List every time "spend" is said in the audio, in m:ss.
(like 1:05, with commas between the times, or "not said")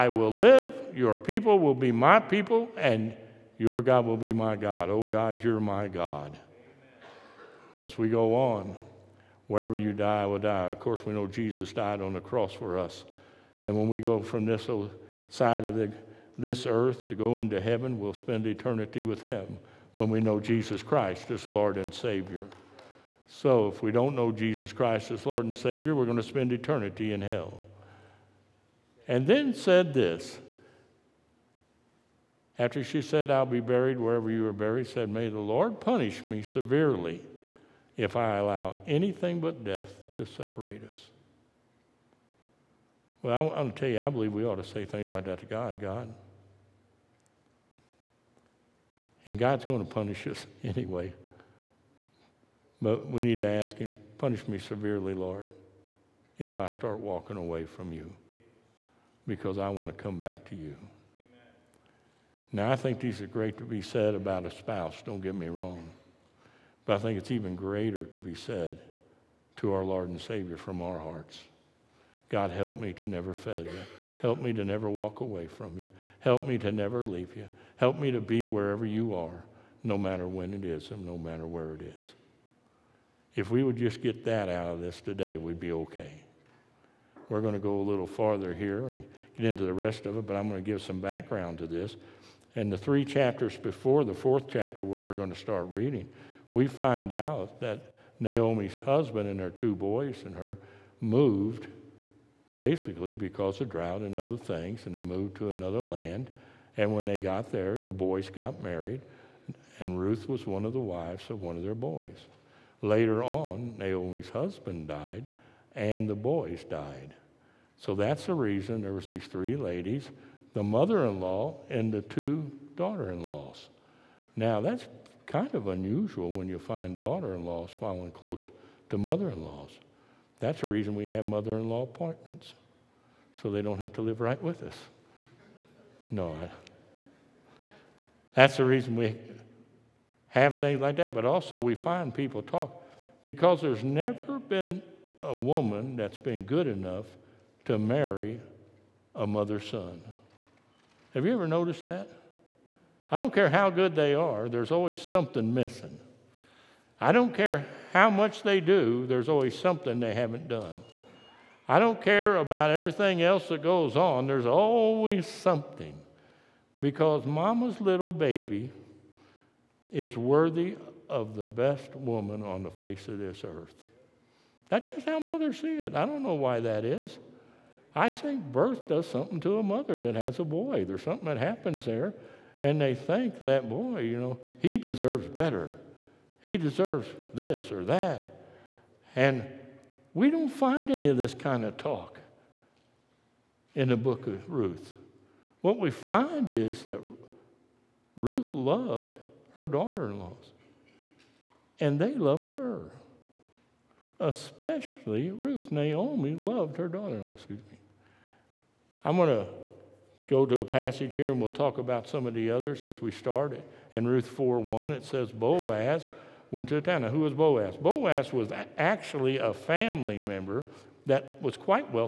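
0:18, 0:26.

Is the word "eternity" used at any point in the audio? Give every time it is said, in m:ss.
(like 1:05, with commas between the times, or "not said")
0:18, 0:26.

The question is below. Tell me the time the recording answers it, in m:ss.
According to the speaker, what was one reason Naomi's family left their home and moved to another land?
1:43.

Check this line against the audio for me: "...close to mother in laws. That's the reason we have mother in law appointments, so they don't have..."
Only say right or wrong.
right.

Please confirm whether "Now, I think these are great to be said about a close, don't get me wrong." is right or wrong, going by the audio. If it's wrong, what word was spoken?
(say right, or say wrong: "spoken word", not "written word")
wrong: "spouse", not "close".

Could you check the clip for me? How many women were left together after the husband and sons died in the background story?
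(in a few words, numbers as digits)
3.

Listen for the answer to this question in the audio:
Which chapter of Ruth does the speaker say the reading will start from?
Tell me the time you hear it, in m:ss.
1:34.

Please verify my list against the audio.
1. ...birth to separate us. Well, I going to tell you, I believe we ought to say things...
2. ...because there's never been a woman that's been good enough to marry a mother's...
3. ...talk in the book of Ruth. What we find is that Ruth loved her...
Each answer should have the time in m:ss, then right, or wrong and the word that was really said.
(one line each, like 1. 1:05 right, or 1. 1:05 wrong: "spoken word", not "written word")
1. 0:39 wrong: "death", not "birth"
2. 2:23 right
3. 3:11 right.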